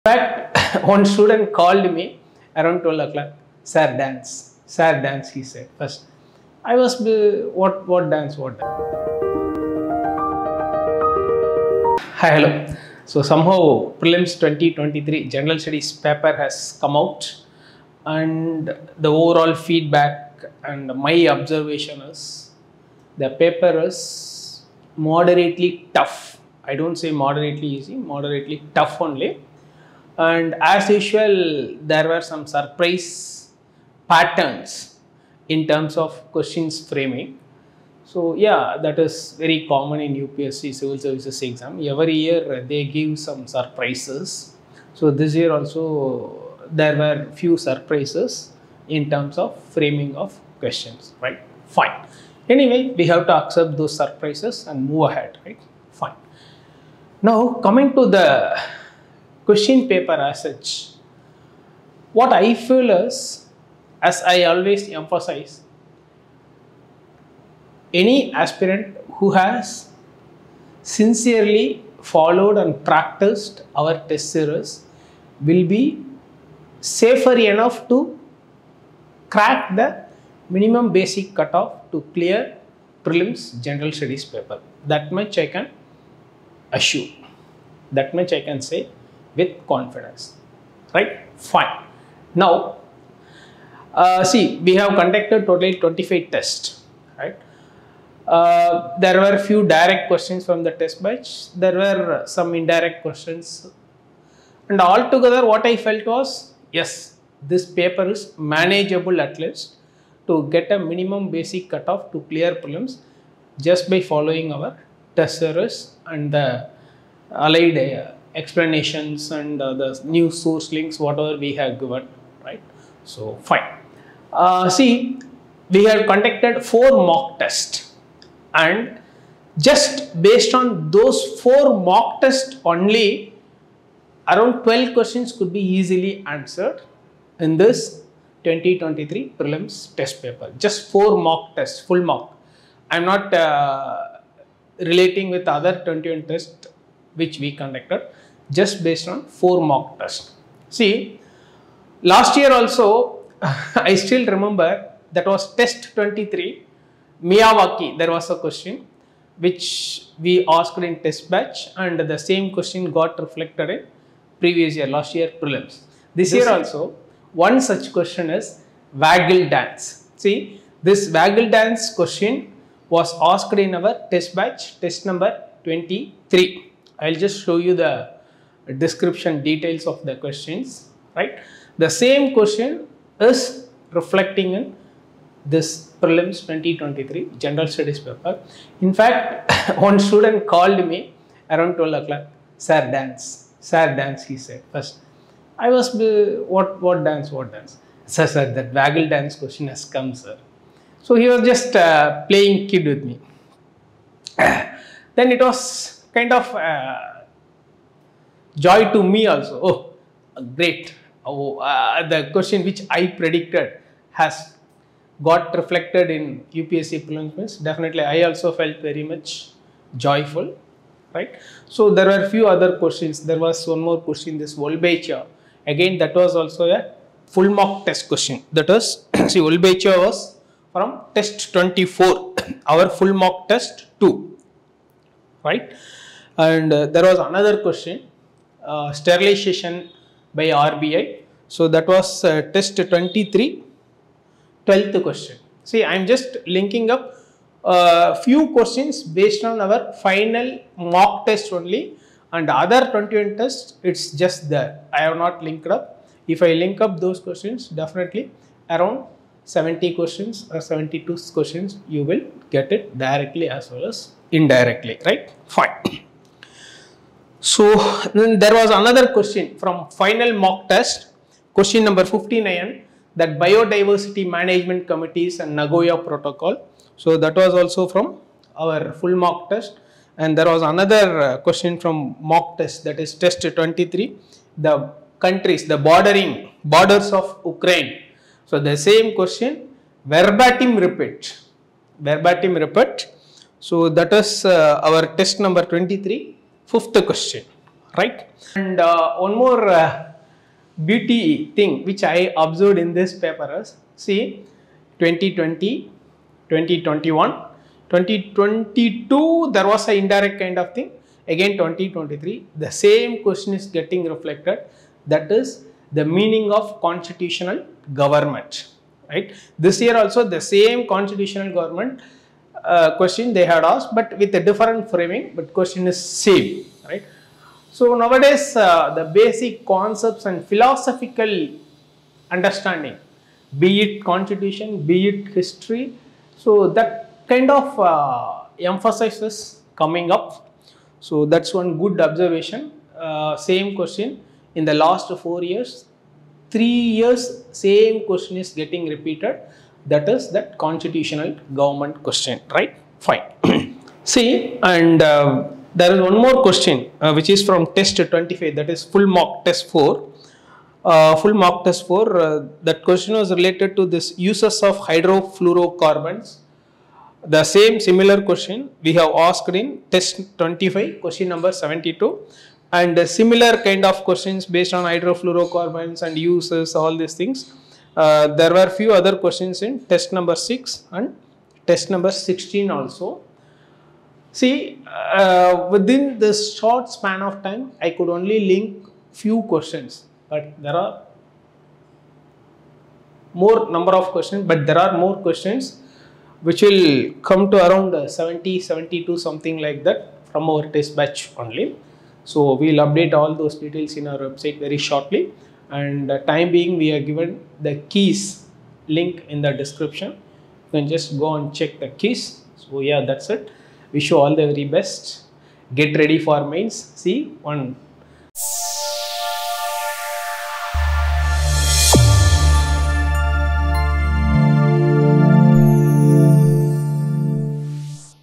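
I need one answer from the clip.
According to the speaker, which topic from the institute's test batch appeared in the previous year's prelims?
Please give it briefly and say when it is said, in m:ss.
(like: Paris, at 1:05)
Miyawaki, at 2:37.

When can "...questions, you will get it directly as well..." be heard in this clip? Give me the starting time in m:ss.
4:21.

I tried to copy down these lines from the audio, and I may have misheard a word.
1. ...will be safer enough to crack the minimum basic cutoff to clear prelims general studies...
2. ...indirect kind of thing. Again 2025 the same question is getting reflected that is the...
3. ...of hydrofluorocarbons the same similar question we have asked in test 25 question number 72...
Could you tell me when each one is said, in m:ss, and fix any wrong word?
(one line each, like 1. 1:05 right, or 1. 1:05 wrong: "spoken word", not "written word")
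1. 1:15 right
2. 5:10 wrong: "2023", not "2025"
3. 6:04 right.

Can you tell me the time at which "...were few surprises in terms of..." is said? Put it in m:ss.
0:46.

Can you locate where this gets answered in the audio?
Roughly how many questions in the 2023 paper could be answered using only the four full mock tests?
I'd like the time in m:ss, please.
2:14.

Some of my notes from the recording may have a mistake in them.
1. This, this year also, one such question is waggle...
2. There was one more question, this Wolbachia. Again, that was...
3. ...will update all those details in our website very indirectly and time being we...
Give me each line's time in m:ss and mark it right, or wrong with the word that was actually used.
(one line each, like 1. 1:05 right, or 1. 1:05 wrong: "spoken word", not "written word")
1. 2:46 right
2. 3:43 right
3. 6:42 wrong: "shortly", not "indirectly".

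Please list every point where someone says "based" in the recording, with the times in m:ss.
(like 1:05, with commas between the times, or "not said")
2:10, 2:28, 4:09, 6:14.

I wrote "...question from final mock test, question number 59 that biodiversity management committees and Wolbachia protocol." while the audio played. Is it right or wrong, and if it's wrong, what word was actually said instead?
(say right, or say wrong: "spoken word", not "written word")
wrong: "Nagoya", not "Wolbachia".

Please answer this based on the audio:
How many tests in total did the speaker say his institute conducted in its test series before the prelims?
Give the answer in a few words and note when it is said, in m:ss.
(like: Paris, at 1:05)
25, at 1:35.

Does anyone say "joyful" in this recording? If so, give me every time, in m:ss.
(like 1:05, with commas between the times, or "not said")
3:39.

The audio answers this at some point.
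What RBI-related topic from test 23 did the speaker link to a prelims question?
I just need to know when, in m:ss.
3:58.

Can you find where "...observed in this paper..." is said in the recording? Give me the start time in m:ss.
5:02.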